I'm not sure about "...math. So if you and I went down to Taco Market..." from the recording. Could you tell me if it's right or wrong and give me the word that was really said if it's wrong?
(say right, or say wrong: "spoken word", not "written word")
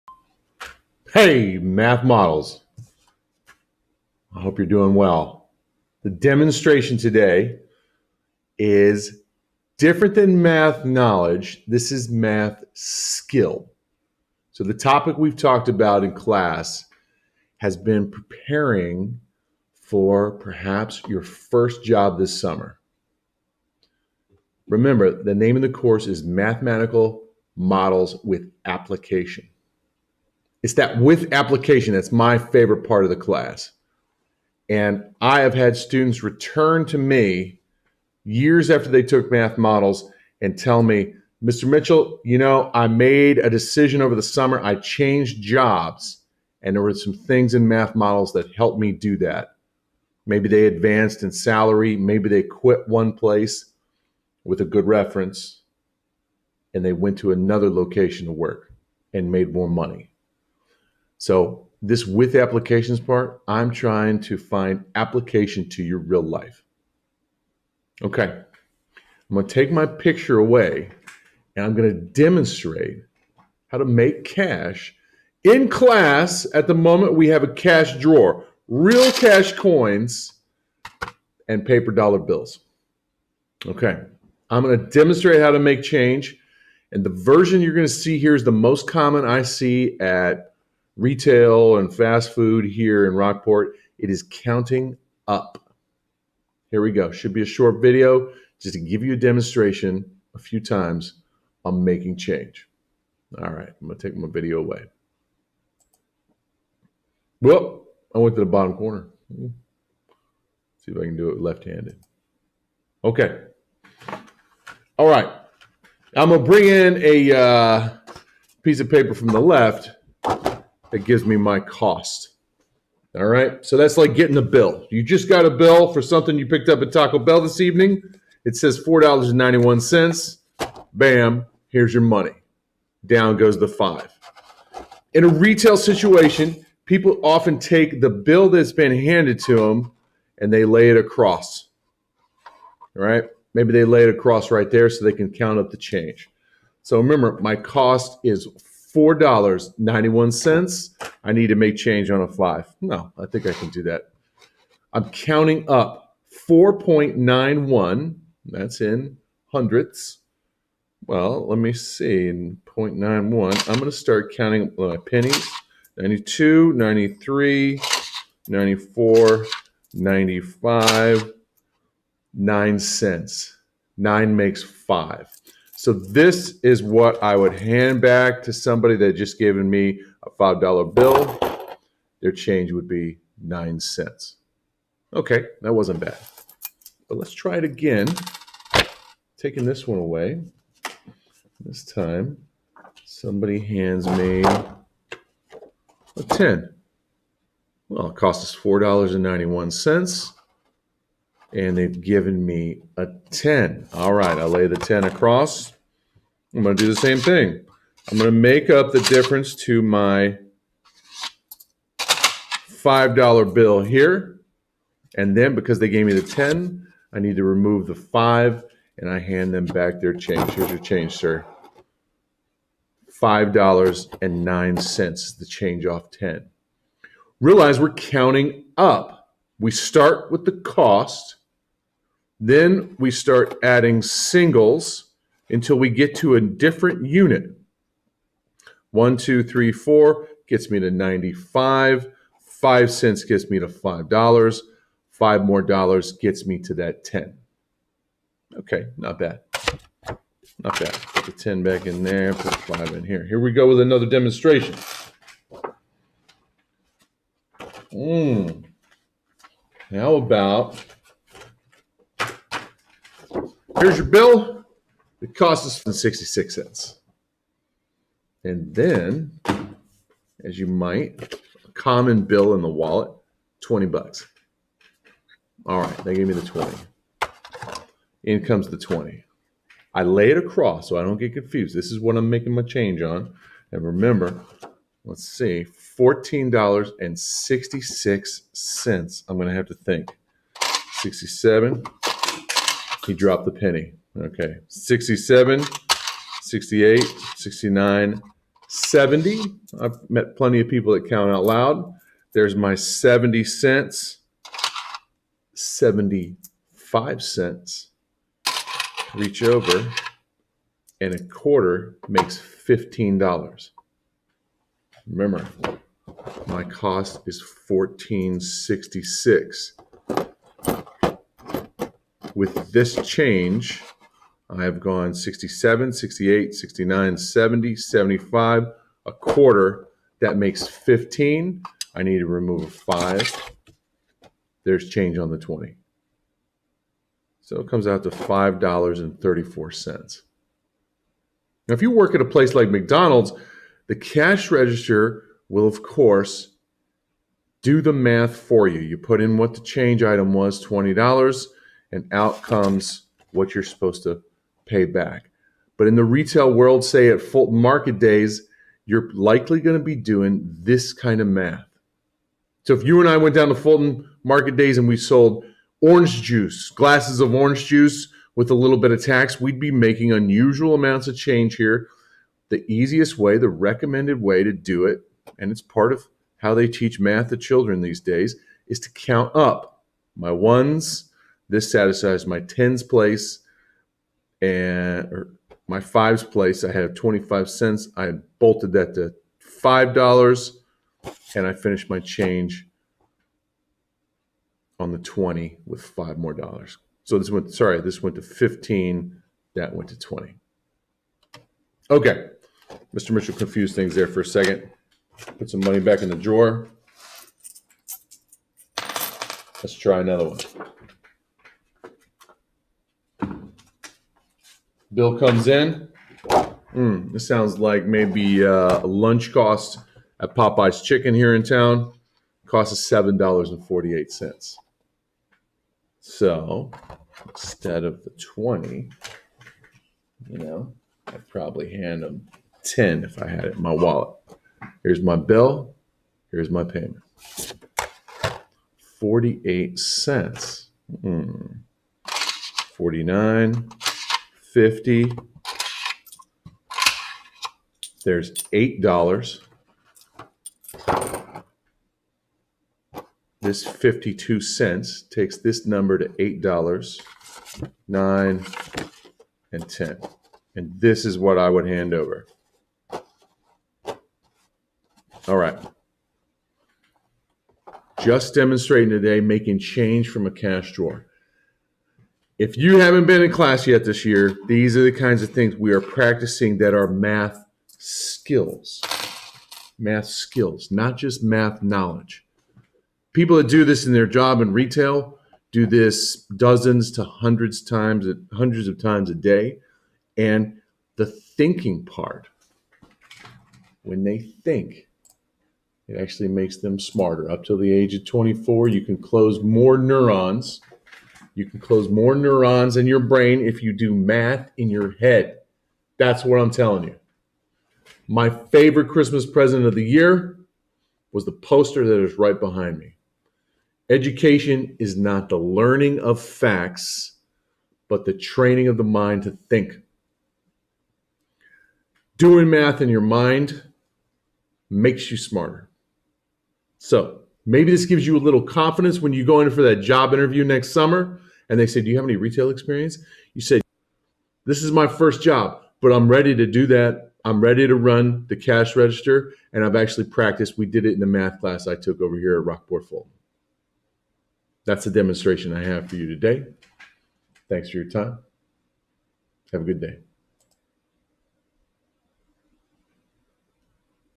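wrong: "Fulton", not "Taco".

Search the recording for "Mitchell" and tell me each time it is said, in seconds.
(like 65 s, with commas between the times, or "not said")
41 s, 403 s.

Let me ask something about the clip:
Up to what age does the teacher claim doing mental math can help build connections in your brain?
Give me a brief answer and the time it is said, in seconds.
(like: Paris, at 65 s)
24, at 498 s.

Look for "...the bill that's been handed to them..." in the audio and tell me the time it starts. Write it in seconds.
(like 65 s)
137 s.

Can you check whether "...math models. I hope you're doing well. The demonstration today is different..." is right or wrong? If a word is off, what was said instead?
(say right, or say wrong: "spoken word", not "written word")
right.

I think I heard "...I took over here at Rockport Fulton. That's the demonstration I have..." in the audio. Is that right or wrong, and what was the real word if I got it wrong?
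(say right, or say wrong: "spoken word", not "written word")
right.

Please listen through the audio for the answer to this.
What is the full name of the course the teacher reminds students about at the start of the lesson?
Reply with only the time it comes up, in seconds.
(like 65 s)
26 s.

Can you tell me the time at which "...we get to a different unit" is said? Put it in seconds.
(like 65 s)
235 s.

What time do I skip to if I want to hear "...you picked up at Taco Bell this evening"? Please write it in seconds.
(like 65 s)
126 s.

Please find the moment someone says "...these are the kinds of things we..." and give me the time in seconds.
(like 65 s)
474 s.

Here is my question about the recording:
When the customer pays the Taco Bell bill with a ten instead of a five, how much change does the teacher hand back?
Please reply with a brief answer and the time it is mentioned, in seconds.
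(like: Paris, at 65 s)
$5.09, at 223 s.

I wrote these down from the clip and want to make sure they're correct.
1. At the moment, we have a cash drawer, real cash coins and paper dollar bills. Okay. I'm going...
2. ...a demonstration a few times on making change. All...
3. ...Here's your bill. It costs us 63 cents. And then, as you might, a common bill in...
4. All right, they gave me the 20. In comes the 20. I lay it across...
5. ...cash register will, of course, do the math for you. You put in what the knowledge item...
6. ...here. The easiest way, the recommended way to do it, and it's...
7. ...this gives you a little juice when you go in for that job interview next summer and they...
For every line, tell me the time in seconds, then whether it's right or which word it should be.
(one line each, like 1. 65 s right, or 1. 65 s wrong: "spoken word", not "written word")
1. 76 s right
2. 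99 s right
3. 263 s wrong: "66", not "63"
4. 275 s right
5. 343 s wrong: "change", not "knowledge"
6. 371 s right
7. 527 s wrong: "confidence", not "juice".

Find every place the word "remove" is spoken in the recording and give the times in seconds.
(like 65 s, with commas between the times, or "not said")
217 s, 332 s.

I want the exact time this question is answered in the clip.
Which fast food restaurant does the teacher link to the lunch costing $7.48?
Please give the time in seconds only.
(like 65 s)
420 s.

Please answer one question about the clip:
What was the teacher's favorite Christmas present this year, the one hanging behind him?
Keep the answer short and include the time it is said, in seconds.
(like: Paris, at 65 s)
the poster, at 511 s.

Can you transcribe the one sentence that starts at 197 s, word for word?
Well, it cost us $4.91 and they've given me a 10.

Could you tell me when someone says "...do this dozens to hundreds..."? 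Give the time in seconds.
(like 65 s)
485 s.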